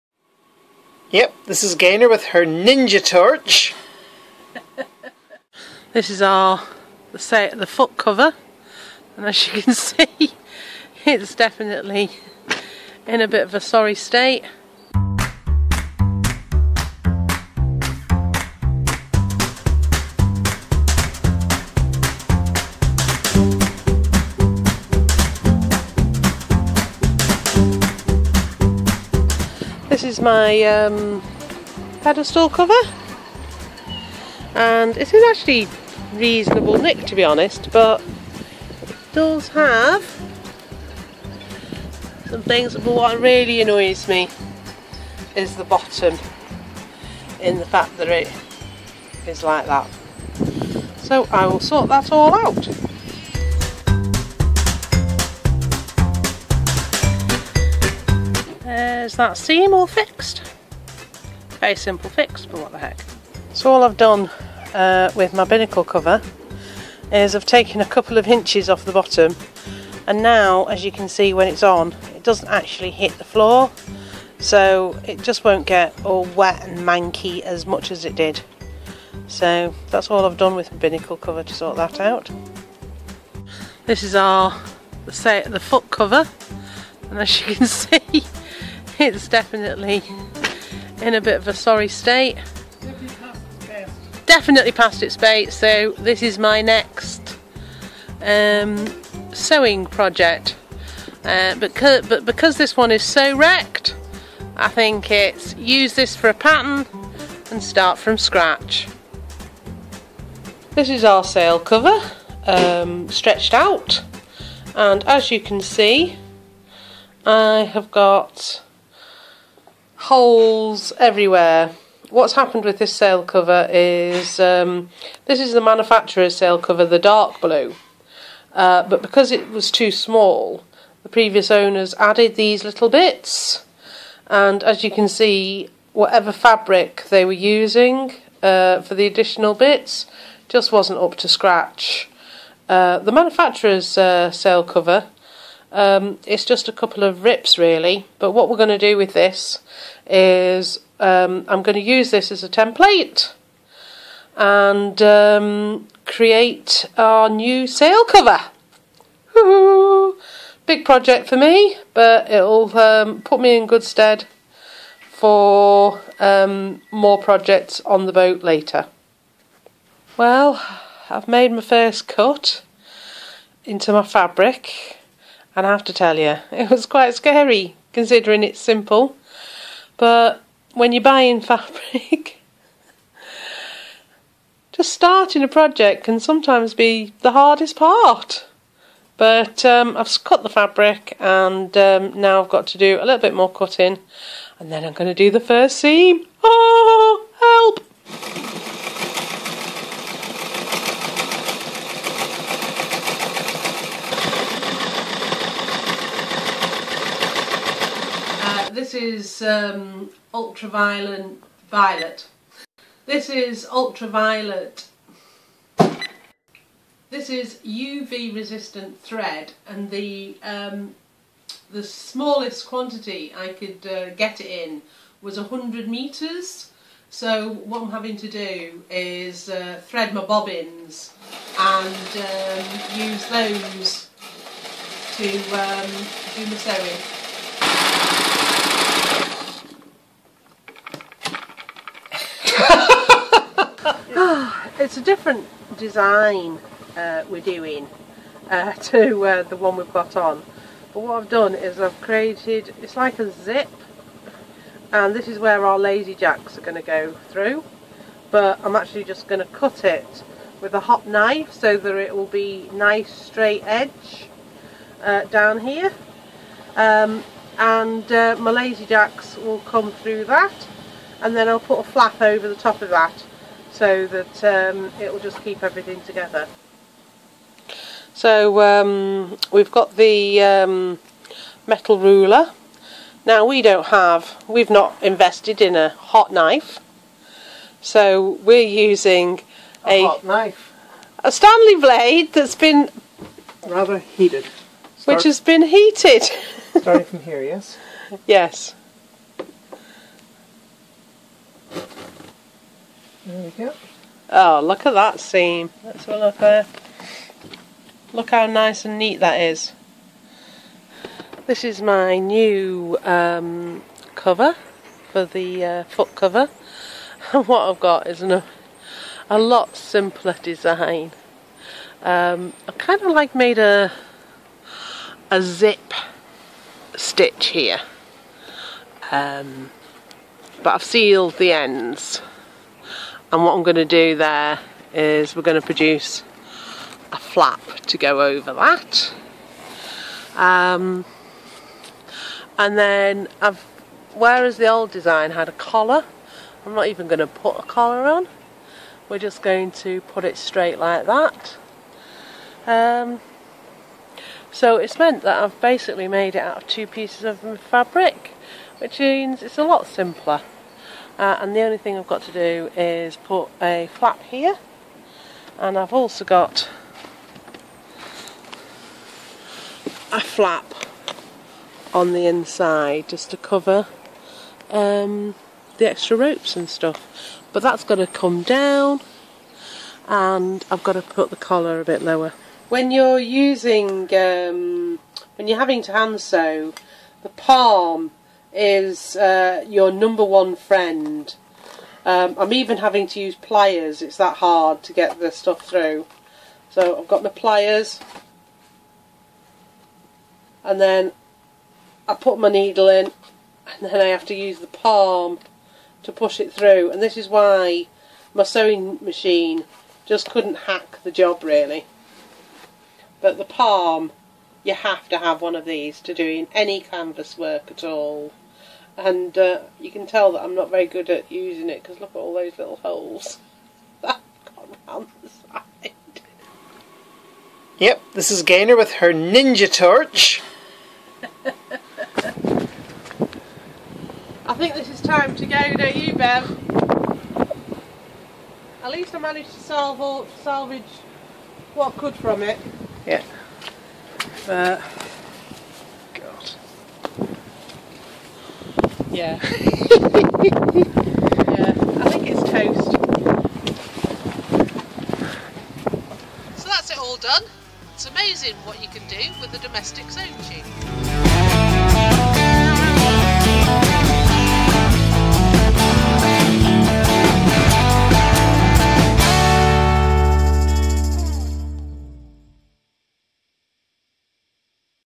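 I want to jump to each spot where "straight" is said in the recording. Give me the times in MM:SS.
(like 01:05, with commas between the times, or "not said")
04:23, 05:50.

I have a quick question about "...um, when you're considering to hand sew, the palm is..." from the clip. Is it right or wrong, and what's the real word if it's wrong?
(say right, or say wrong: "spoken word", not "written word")
wrong: "having", not "considering".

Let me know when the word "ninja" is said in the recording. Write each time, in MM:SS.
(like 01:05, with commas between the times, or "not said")
00:02, 07:09.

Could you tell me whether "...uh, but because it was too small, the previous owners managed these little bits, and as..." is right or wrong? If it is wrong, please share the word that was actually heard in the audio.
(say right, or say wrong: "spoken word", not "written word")
wrong: "added", not "managed".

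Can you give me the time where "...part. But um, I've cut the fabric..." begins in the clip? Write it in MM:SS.
03:07.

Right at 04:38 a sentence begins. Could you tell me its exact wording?
So um, we've got the um, metal ruler.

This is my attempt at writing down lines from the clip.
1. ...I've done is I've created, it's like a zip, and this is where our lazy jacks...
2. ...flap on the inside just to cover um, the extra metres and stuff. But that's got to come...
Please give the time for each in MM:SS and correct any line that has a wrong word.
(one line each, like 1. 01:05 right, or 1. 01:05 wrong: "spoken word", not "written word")
1. 04:11 right
2. 06:10 wrong: "ropes", not "metres".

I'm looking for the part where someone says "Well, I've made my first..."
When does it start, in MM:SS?
02:50.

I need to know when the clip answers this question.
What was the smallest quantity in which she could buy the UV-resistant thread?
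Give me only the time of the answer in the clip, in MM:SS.
03:45.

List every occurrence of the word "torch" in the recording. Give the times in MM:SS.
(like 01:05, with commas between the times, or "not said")
00:03, 07:09.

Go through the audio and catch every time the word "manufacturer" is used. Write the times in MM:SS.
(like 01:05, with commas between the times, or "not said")
02:05, 02:23.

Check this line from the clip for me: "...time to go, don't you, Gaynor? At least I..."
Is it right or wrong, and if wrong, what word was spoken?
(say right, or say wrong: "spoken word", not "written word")
wrong: "Bev", not "Gaynor".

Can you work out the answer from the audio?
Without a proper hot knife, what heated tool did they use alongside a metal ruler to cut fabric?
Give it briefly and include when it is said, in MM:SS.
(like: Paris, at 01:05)
Stanley blade, at 04:51.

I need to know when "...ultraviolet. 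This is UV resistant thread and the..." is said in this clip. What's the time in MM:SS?
03:33.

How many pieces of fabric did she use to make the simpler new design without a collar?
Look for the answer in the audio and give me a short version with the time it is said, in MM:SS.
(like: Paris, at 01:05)
2, at 05:56.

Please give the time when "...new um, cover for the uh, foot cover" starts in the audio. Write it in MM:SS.
05:12.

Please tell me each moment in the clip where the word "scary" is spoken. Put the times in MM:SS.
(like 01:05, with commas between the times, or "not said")
02:57.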